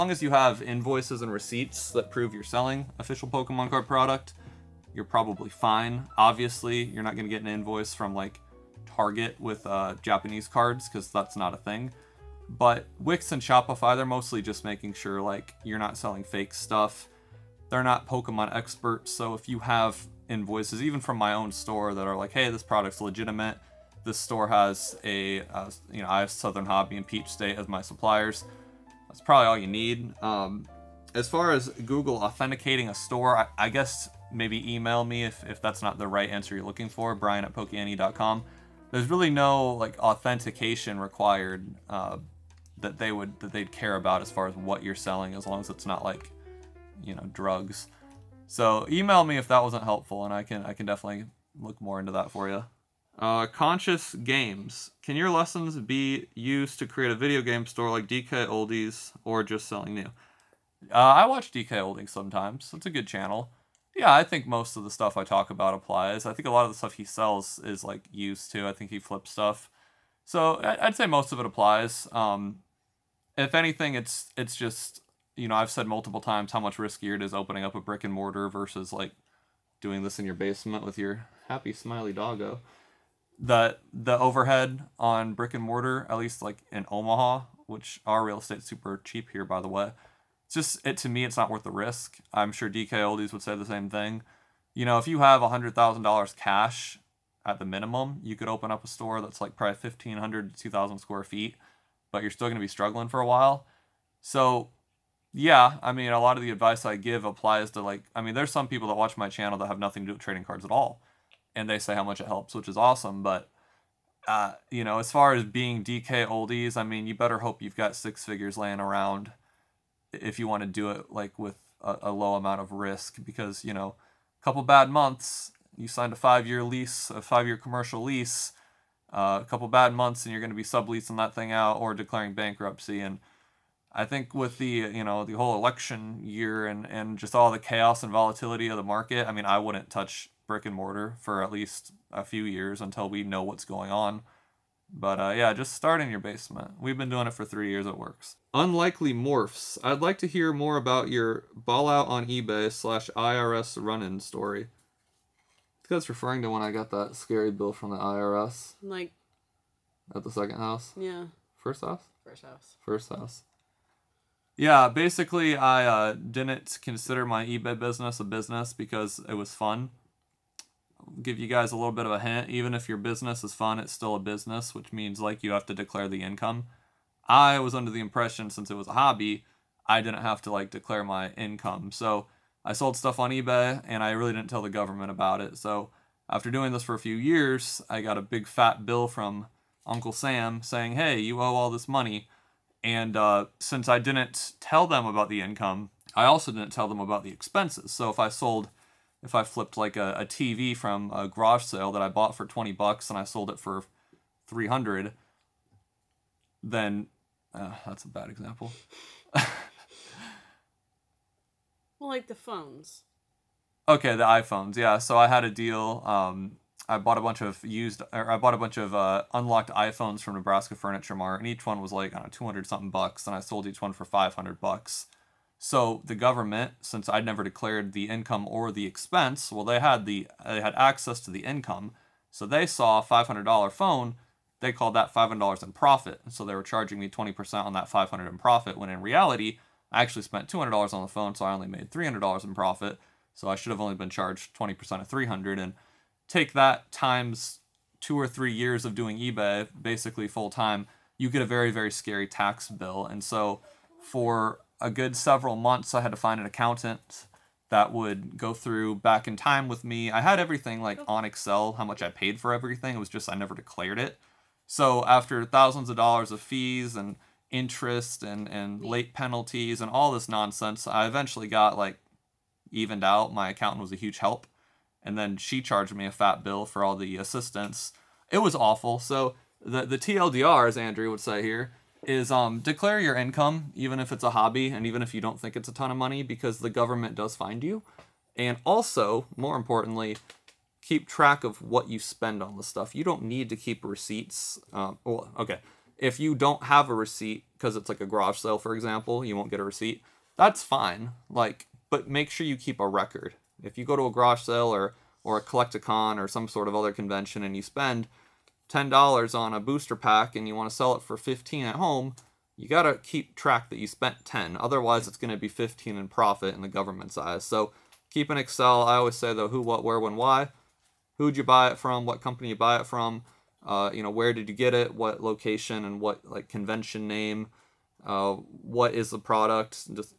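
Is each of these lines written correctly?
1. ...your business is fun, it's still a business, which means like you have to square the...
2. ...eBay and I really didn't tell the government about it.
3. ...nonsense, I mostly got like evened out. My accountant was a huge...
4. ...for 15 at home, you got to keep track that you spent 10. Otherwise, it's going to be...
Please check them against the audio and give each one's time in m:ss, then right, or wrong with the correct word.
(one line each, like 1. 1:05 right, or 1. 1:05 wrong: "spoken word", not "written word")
1. 2:52 wrong: "declare", not "square"
2. 3:03 right
3. 4:30 wrong: "eventually", not "mostly"
4. 5:11 right.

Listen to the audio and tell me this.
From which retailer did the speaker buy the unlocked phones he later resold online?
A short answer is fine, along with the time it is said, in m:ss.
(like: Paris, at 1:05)
Nebraska Furniture Mart, at 3:40.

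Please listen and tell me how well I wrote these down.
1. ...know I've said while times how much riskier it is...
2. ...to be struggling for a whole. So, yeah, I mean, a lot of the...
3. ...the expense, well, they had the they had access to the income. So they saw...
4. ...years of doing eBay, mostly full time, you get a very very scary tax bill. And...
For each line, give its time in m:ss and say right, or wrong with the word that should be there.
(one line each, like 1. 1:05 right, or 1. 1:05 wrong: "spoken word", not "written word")
1. 1:15 wrong: "multiple", not "while"
2. 1:42 wrong: "while", not "whole"
3. 3:48 right
4. 4:08 wrong: "basically", not "mostly".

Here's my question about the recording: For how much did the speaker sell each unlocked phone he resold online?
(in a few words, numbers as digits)
$500.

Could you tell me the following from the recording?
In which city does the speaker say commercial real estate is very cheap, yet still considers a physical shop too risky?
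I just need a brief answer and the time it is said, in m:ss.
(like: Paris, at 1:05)
Omaha, at 1:26.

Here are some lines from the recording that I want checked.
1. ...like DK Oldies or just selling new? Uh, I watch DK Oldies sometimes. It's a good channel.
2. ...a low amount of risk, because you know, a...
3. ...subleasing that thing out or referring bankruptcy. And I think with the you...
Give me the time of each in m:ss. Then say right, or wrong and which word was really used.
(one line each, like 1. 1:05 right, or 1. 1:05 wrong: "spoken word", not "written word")
1. 0:57 right
2. 2:02 right
3. 2:10 wrong: "declaring", not "referring".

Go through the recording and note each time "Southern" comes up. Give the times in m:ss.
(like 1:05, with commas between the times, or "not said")
0:26.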